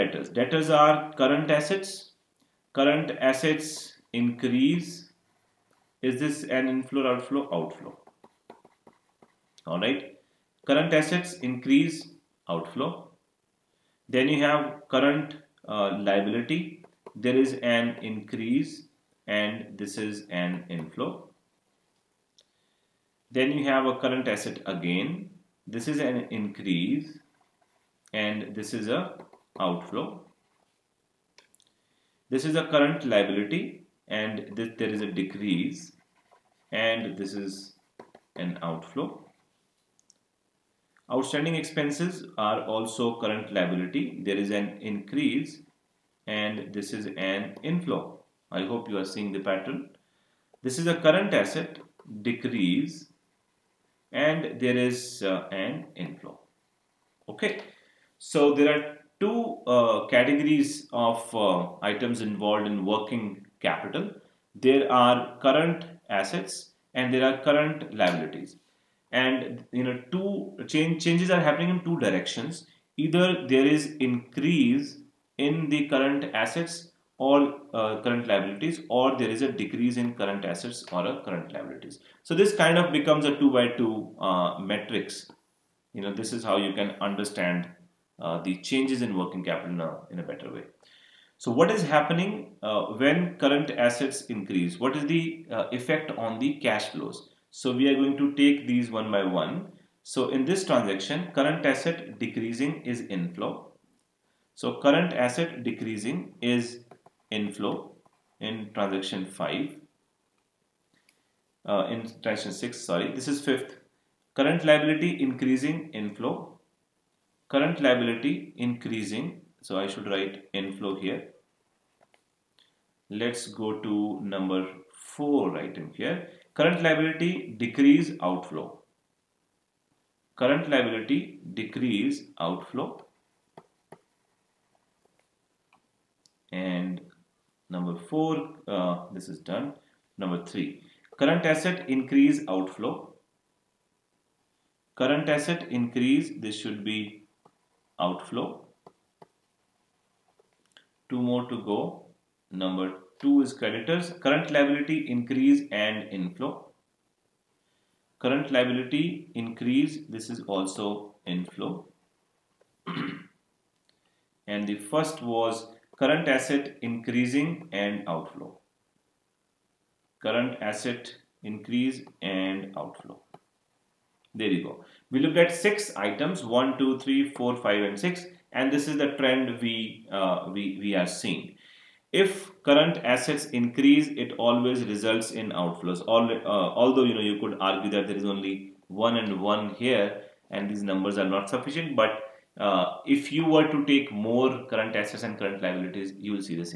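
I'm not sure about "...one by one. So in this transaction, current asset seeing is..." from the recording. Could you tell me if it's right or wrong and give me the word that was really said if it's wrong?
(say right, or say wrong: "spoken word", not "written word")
wrong: "decreasing", not "seeing".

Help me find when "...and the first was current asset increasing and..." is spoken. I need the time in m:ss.
2:44.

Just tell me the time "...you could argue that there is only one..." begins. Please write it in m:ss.
3:07.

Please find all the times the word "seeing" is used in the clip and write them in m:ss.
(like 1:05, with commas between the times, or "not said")
0:49, 3:01.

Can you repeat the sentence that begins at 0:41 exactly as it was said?
Outstanding expenses are also current liability.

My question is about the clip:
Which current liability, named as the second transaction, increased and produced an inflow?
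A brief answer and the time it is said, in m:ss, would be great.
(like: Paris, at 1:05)
Creditors, at 2:33.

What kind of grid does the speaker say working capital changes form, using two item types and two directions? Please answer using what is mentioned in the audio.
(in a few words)
2 by 2 matrix.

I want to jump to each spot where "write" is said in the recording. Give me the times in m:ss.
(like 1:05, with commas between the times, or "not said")
2:00.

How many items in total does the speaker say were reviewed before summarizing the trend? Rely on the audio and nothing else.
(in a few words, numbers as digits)
6.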